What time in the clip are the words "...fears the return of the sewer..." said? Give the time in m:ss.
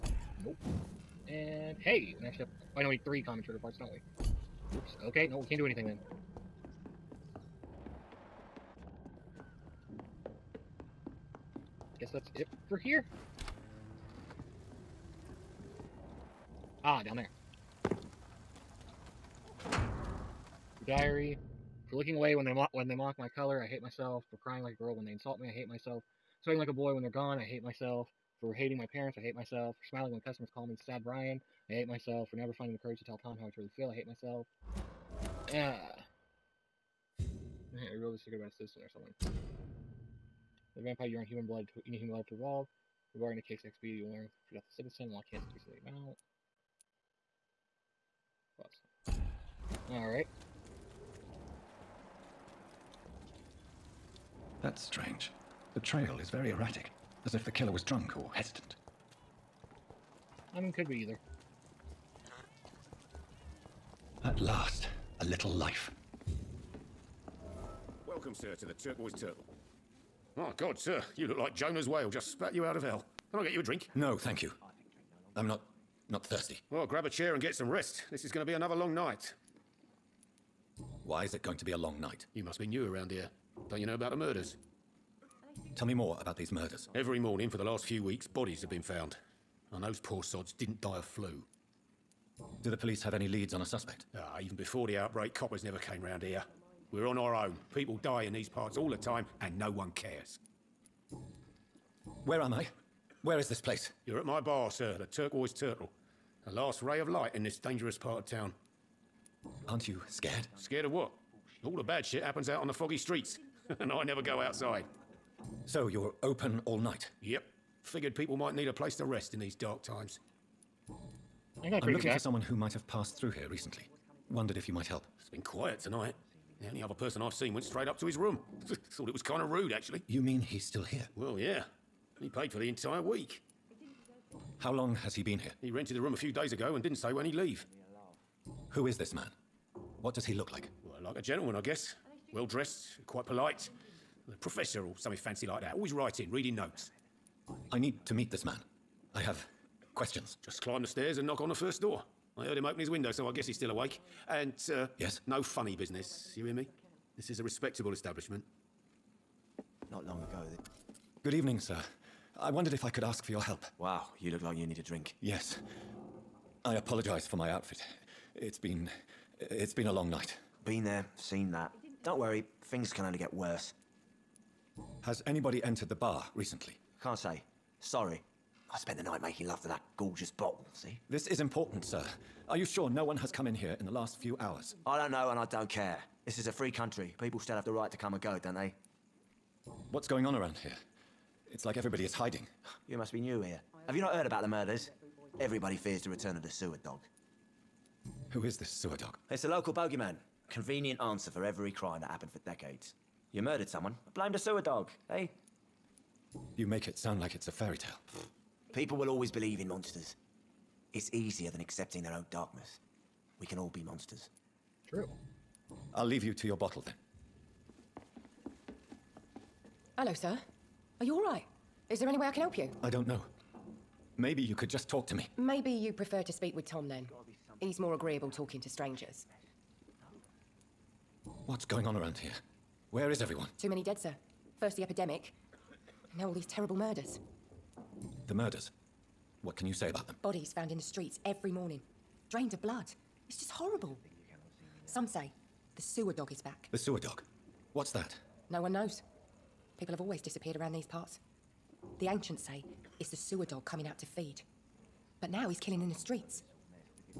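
3:15.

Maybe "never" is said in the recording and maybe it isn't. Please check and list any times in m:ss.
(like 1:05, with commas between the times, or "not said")
0:32, 1:35, 1:54.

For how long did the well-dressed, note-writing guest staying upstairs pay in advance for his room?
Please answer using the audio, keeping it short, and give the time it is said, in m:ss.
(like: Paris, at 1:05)
the entire week, at 2:12.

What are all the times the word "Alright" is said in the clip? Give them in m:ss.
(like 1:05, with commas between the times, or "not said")
0:49.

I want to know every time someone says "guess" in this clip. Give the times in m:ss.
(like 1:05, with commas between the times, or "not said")
0:11, 2:21, 2:33.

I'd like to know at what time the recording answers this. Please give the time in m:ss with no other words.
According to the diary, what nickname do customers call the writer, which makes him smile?
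0:30.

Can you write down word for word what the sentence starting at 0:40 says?
The vampire urine human blood to eating human blood to evolve.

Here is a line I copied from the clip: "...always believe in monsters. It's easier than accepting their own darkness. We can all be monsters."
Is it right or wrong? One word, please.
right.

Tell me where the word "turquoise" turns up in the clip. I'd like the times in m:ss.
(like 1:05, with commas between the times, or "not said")
1:08, 1:45.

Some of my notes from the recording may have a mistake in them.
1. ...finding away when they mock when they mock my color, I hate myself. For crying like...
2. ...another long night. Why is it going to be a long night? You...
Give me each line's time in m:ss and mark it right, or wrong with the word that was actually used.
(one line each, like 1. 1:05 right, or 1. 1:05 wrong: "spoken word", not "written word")
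1. 0:21 wrong: "looking", not "finding"
2. 1:18 right.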